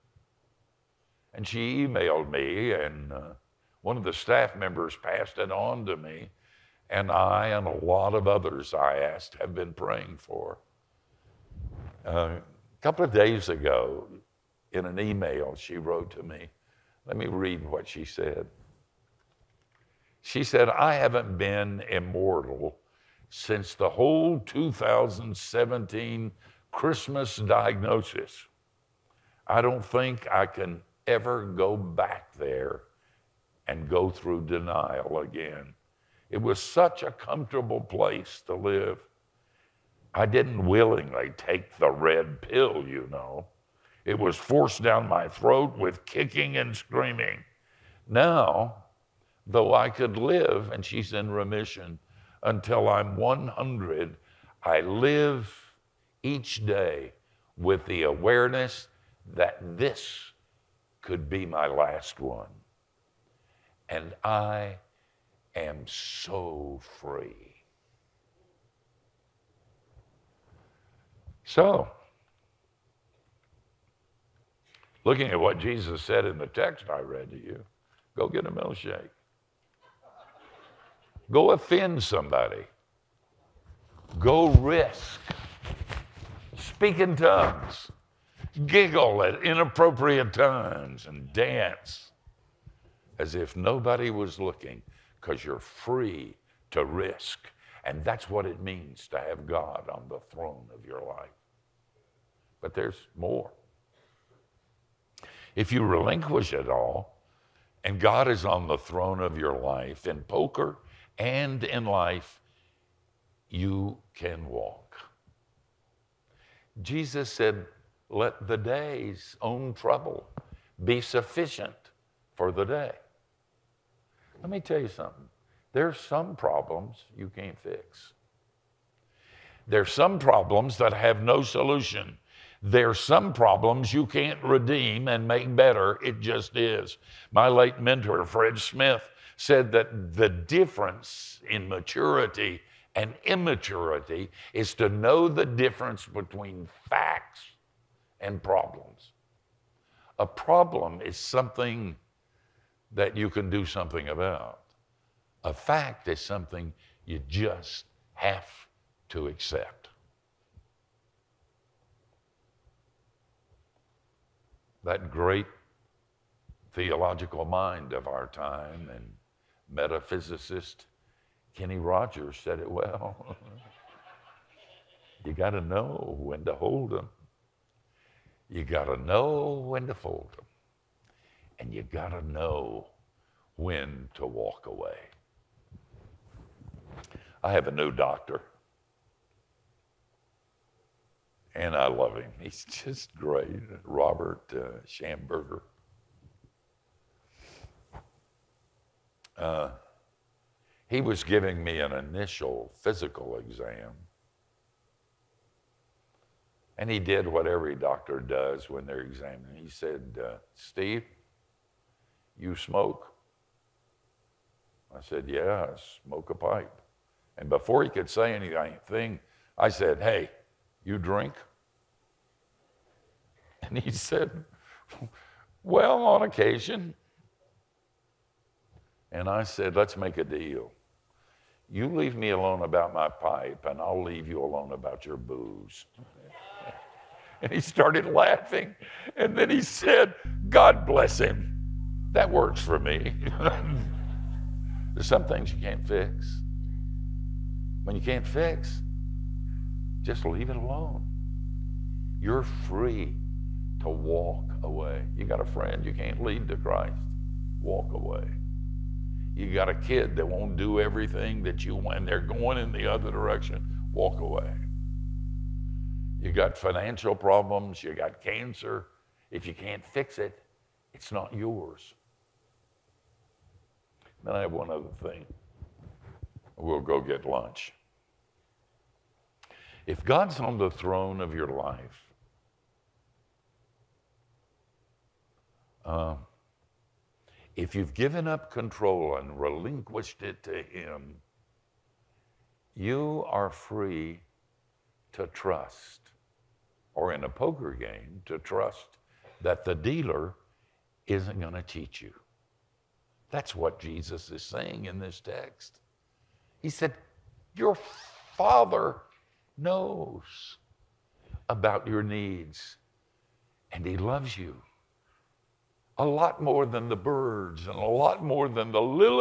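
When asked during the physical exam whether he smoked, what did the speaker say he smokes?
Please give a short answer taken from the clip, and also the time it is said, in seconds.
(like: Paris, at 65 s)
A pipe, at 216 s.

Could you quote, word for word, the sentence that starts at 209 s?
He said, uh, Steve, you smoke?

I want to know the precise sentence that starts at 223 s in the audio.
And he said, Well, on occasion.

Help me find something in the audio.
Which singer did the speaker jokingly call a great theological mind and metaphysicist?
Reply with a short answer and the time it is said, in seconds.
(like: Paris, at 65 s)
Kenny Rogers, at 171 s.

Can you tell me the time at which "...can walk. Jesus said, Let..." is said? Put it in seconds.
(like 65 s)
114 s.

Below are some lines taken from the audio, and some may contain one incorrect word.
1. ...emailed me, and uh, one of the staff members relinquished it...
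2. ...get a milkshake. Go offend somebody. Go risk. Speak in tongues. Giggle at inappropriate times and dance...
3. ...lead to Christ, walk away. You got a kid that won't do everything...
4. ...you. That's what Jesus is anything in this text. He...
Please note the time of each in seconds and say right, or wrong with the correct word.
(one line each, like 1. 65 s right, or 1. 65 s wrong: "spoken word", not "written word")
1. 1 s wrong: "passed", not "relinquished"
2. 78 s right
3. 256 s right
4. 302 s wrong: "saying", not "anything".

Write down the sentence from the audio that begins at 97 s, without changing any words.
And that's what it means to have God on the throne of your life but there's more.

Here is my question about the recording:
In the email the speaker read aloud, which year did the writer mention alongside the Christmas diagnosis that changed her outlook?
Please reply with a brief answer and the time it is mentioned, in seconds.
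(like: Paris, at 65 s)
2017, at 24 s.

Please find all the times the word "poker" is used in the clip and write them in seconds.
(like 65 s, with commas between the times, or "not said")
110 s, 297 s.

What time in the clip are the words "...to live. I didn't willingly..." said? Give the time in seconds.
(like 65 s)
38 s.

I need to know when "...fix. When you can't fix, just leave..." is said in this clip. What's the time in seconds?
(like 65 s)
245 s.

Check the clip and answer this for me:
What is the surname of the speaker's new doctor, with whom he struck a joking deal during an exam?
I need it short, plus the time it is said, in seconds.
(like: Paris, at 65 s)
Schamberger, at 194 s.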